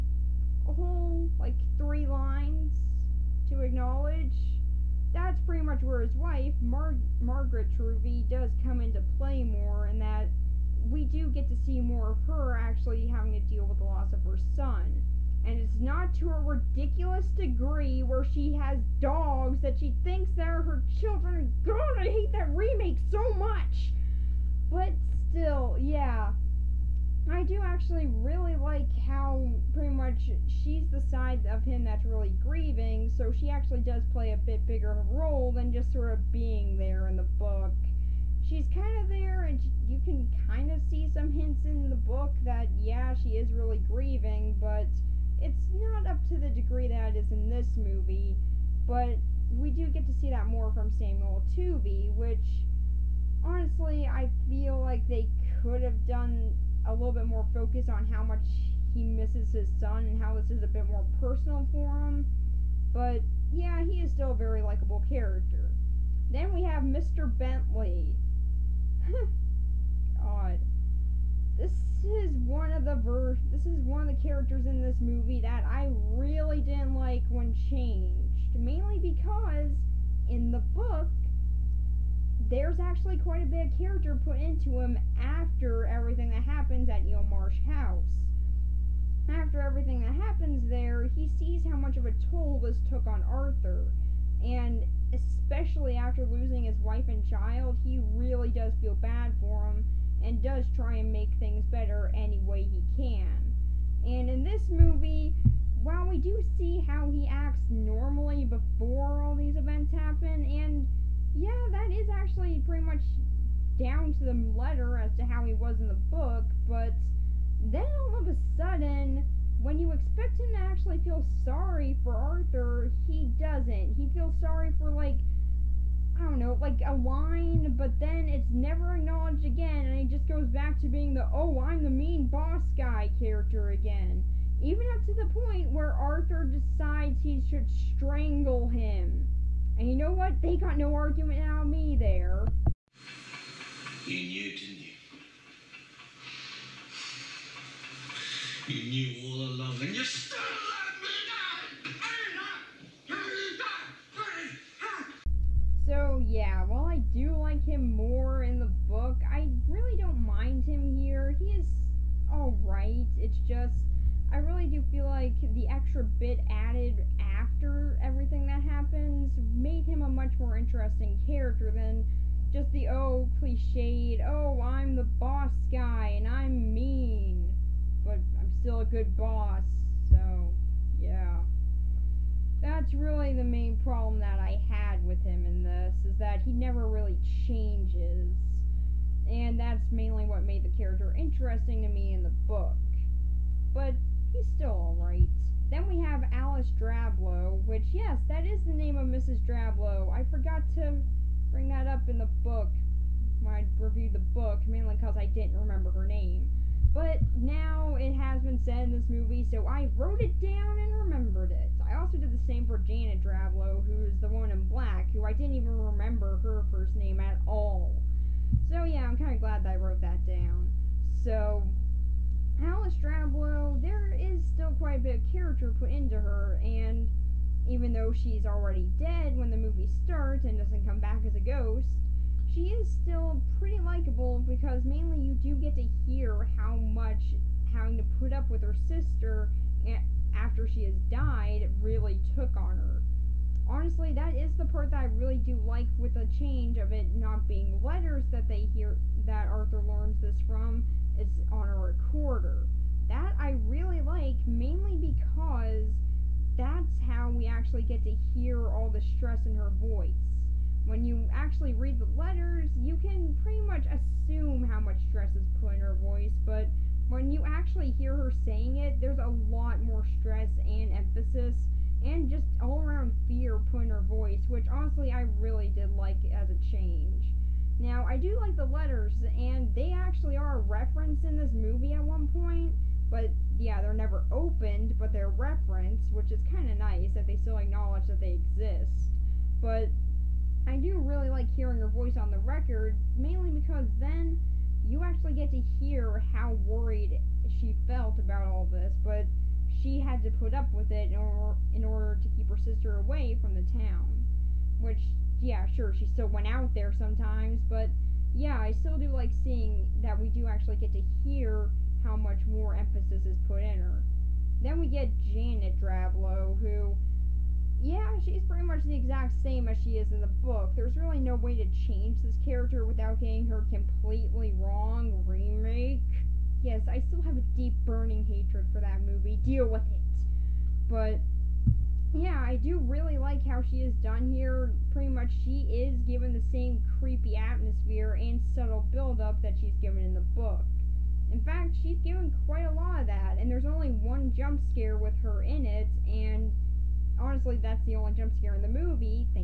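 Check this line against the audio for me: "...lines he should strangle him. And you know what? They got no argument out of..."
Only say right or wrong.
wrong.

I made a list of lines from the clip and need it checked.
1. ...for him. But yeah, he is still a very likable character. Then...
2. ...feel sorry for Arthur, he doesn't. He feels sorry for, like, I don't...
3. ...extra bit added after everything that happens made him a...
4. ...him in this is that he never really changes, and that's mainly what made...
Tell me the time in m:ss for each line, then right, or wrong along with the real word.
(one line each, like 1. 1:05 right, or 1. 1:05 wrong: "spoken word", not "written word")
1. 1:01 right
2. 2:00 right
3. 2:45 right
4. 3:05 right.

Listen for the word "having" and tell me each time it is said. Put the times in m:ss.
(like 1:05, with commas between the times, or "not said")
0:13, 3:57.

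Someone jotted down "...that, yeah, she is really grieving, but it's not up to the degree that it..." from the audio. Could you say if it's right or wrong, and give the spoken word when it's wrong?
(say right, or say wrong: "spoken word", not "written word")
right.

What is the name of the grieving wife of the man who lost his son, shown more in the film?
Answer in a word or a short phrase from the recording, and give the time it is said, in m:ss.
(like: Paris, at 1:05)
Margaret Truvy, at 0:07.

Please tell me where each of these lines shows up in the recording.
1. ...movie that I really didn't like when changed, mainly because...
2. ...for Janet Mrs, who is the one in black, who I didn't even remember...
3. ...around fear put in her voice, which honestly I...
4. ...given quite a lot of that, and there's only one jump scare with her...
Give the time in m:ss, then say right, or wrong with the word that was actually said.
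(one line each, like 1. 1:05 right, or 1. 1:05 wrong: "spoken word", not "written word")
1. 1:14 right
2. 3:32 wrong: "Drablow", not "Mrs"
3. 4:32 right
4. 5:42 right.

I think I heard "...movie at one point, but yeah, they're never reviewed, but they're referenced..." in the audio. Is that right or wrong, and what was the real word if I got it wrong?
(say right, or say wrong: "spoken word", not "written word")
wrong: "opened", not "reviewed".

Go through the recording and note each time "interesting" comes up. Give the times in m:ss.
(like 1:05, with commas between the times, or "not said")
2:50, 3:11.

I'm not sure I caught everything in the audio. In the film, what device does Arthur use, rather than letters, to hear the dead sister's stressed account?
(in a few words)
a recorder.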